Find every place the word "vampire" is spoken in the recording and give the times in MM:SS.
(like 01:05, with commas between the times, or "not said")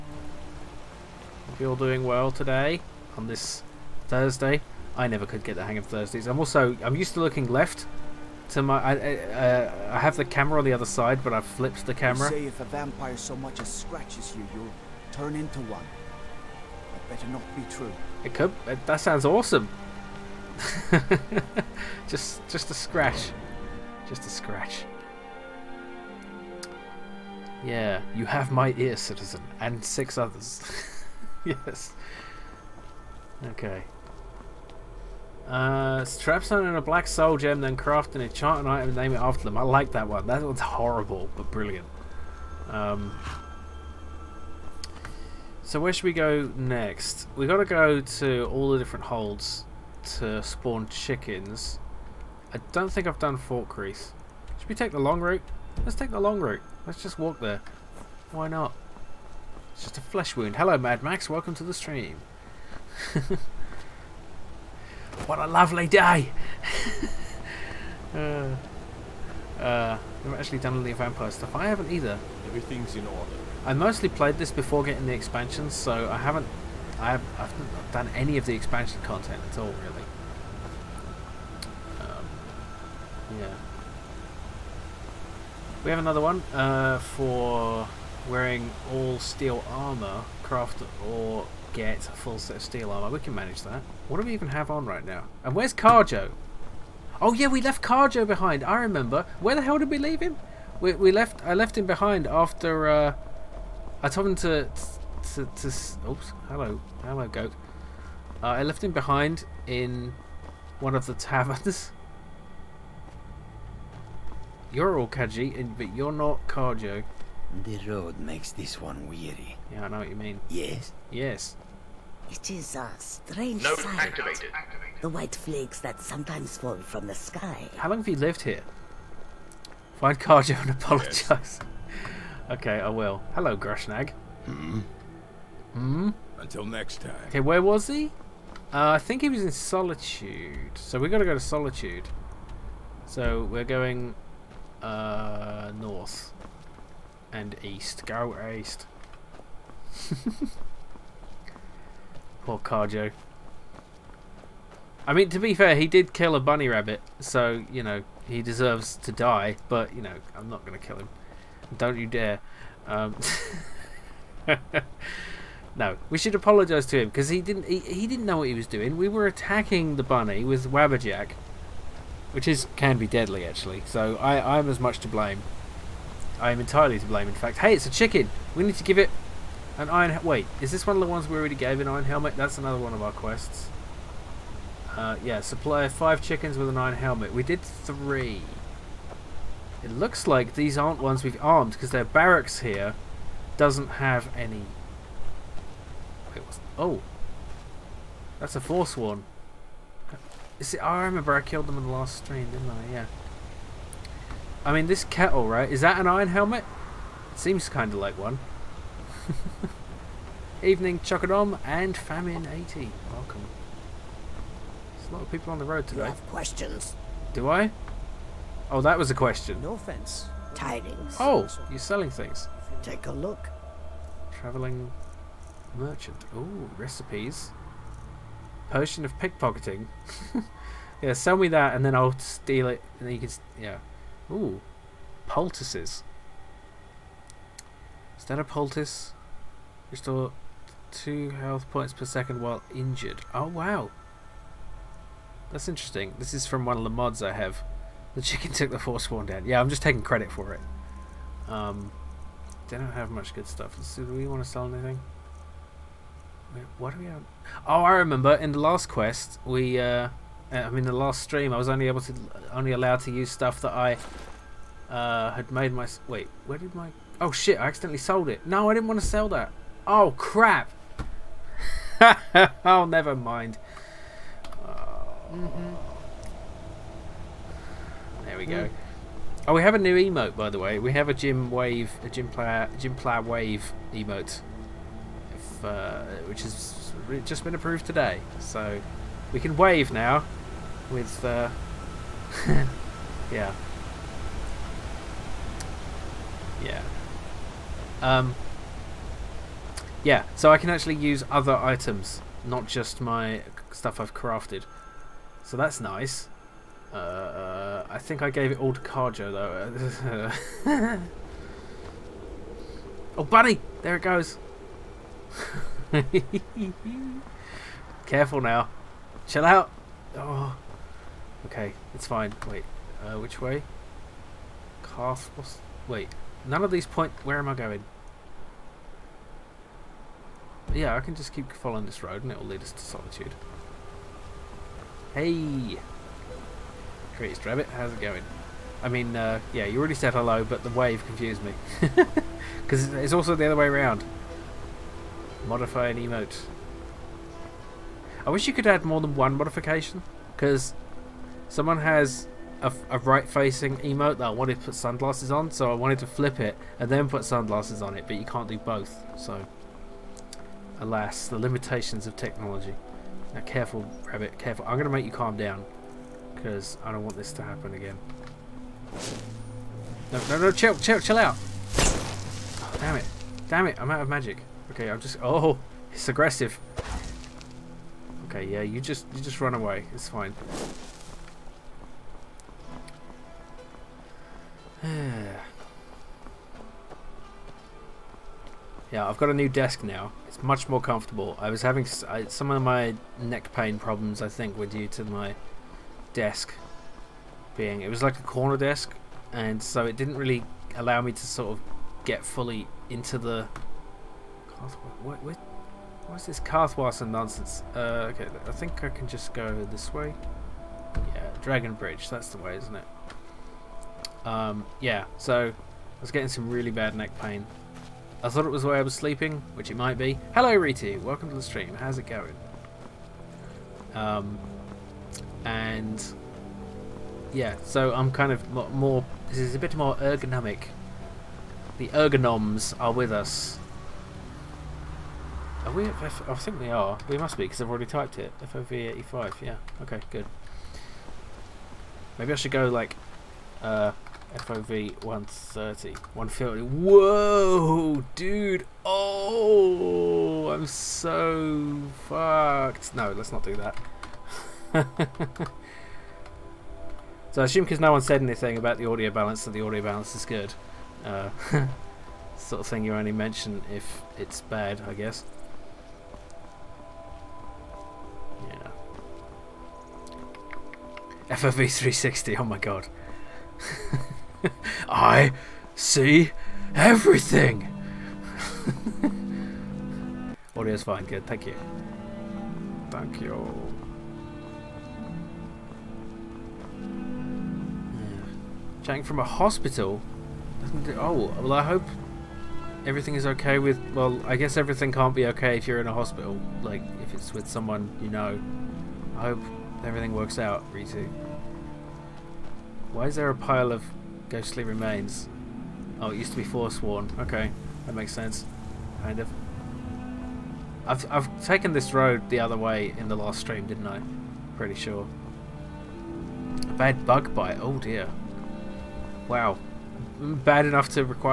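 00:12, 01:10.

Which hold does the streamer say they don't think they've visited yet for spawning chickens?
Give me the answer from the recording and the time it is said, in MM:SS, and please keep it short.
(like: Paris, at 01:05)
Falkreath, at 00:53.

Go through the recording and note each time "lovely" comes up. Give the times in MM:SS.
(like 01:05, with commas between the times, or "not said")
01:05.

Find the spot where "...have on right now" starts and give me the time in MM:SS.
01:34.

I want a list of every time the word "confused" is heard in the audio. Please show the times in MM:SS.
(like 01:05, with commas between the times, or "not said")
05:41.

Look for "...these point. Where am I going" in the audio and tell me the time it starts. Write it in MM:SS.
05:26.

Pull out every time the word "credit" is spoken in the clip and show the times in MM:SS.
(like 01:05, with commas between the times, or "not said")
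04:10.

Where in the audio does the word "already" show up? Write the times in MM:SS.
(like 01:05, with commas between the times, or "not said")
03:01, 05:39, 07:17.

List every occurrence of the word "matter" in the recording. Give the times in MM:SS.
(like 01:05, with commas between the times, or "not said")
not said.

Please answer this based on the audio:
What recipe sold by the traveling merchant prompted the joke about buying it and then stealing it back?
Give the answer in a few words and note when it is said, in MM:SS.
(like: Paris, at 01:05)
Potion of pickpocketing, at 03:48.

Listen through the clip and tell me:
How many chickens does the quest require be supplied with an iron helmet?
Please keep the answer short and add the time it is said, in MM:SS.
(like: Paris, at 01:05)
5, at 03:05.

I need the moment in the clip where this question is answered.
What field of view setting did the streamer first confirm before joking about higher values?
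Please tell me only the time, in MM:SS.
07:18.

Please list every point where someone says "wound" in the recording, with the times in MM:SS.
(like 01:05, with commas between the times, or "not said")
01:00.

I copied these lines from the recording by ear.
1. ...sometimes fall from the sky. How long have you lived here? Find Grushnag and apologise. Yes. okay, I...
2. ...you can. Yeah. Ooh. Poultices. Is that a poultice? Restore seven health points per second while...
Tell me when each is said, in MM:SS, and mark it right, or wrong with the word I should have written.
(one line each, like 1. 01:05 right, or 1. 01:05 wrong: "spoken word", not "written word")
1. 02:05 wrong: "Kharjo", not "Grushnag"
2. 03:53 wrong: "two", not "seven".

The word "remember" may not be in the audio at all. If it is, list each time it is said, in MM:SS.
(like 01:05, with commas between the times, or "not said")
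01:38, 03:21, 04:17.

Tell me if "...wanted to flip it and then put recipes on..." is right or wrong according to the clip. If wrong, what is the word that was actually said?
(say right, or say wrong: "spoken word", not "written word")
wrong: "sunglasses", not "recipes".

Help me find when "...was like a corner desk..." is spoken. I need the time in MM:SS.
06:37.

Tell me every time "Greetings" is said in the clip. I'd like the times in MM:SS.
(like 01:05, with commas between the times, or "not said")
05:37.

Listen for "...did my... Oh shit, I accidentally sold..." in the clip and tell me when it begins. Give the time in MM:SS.
04:26.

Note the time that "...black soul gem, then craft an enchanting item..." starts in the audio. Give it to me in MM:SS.
00:36.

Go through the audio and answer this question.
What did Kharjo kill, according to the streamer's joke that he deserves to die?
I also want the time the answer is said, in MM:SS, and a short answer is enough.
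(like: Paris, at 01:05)
A bunny rabbit, at 02:36.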